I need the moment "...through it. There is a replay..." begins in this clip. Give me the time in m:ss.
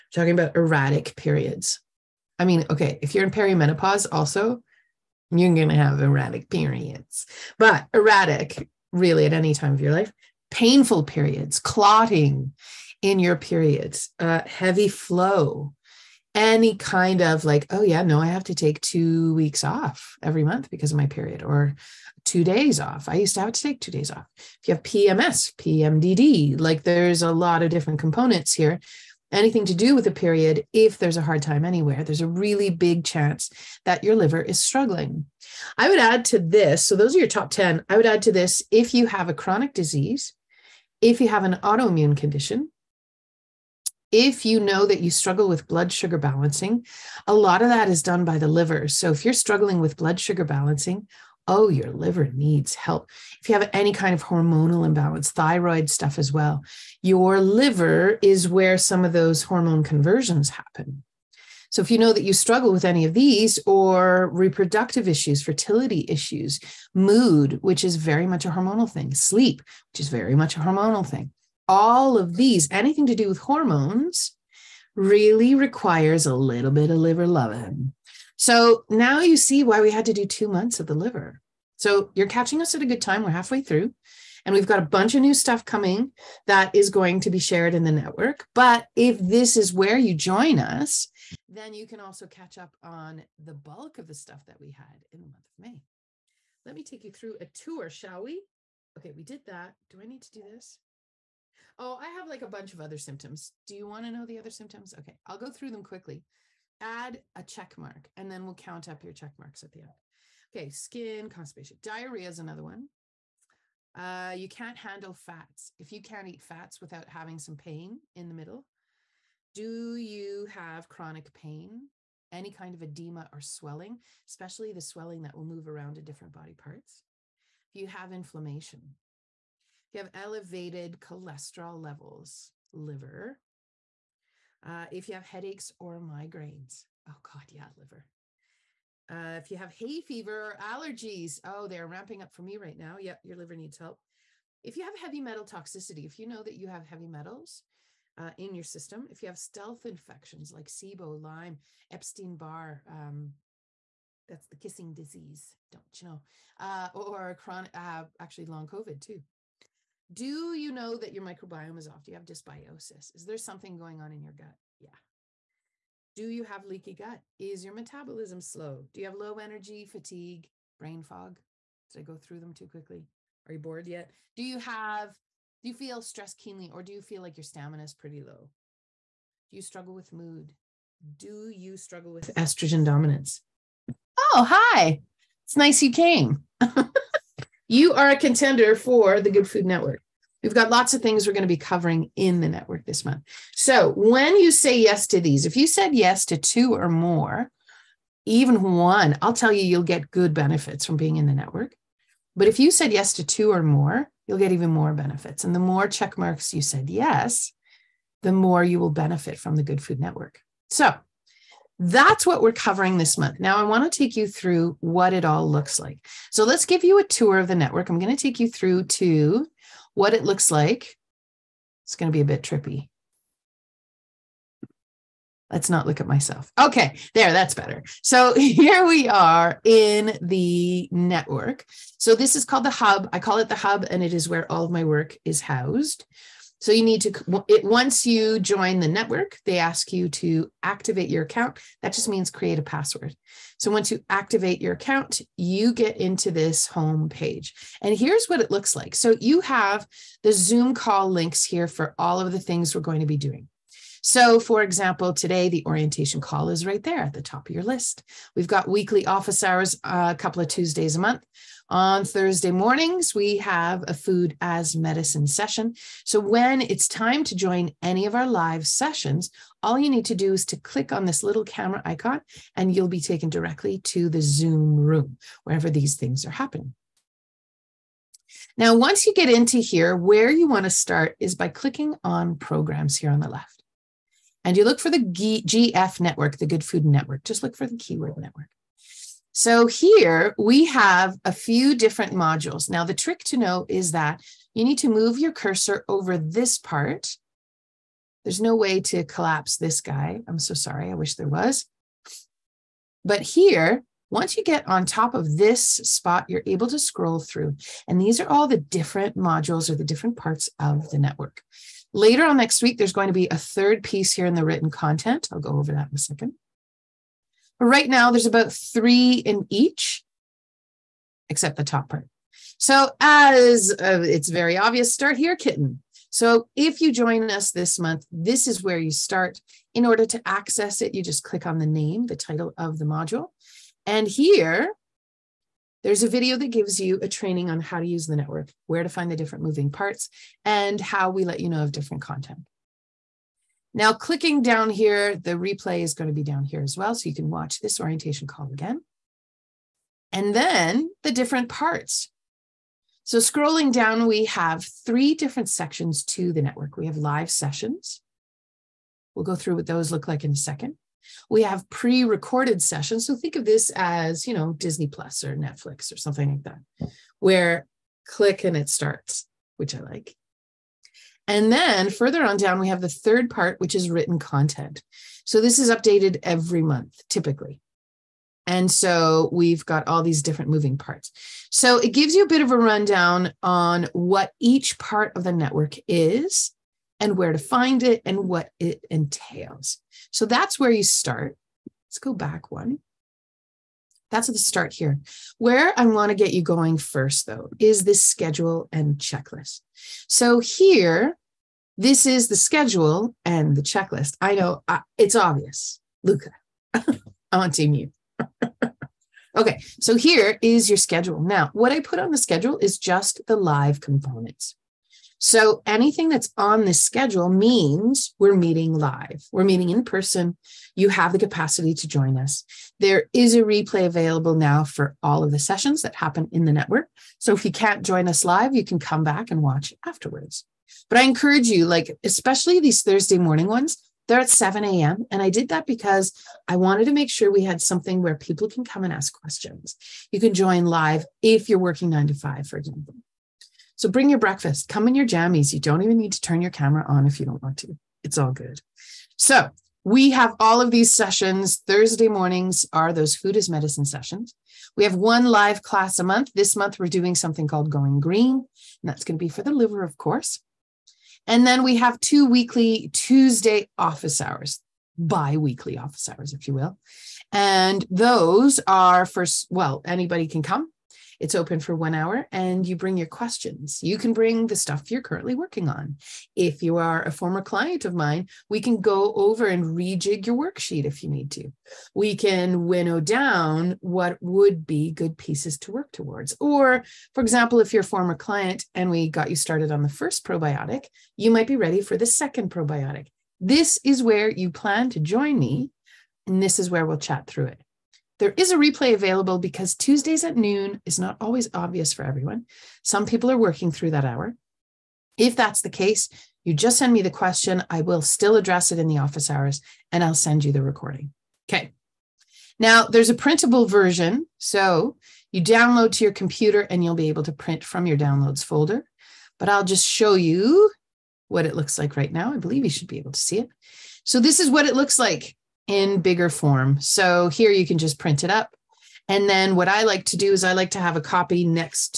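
8:17.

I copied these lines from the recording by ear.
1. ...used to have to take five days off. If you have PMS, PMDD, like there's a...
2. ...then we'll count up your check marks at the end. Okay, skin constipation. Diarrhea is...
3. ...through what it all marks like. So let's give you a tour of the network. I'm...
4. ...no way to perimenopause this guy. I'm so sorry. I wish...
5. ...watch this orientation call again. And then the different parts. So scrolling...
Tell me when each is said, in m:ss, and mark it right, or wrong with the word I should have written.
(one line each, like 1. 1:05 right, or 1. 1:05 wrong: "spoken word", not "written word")
1. 0:23 wrong: "two", not "five"
2. 1:48 right
3. 3:34 wrong: "looks", not "marks"
4. 4:58 wrong: "collapse", not "perimenopause"
5. 5:47 right.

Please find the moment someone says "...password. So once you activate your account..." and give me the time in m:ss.
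4:02.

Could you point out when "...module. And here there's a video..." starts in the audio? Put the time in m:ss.
5:32.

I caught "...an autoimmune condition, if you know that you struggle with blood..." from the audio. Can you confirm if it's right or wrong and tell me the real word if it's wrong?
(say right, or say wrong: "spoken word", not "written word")
right.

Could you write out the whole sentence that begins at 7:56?
If you are a former client of mine, we can go over and rejig your worksheet if you need to.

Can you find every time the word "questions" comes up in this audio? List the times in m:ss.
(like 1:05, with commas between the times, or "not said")
7:19, 7:53, 8:27.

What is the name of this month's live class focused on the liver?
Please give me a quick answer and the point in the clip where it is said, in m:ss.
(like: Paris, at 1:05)
Going Green, at 7:37.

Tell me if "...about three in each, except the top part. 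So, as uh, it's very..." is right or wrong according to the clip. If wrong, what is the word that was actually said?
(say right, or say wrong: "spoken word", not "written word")
right.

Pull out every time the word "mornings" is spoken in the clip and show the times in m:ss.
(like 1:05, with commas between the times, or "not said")
4:22, 7:13, 7:32.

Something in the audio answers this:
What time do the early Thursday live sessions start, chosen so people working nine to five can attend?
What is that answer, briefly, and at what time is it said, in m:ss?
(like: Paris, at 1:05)
7 a.m., at 7:14.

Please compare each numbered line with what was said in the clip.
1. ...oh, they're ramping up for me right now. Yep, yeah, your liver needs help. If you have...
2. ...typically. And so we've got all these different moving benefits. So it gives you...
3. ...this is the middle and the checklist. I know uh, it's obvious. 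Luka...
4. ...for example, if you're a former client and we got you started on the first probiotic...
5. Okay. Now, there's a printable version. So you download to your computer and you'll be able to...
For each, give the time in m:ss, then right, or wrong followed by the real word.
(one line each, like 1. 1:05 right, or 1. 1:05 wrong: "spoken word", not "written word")
1. 2:21 right
2. 6:17 wrong: "parts", not "benefits"
3. 6:41 wrong: "schedule", not "middle"
4. 8:07 right
5. 8:31 right.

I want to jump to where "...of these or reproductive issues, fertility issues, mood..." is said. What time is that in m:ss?
1:03.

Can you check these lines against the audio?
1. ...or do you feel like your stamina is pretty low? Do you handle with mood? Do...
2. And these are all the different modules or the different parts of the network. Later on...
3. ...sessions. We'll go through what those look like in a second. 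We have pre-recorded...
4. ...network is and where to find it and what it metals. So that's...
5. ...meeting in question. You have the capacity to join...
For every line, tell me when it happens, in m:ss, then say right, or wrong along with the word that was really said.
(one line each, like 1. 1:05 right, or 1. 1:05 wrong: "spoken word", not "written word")
1. 2:56 wrong: "struggle", not "handle"
2. 5:07 right
3. 5:57 right
4. 6:25 wrong: "entails", not "metals"
5. 6:59 wrong: "person", not "question".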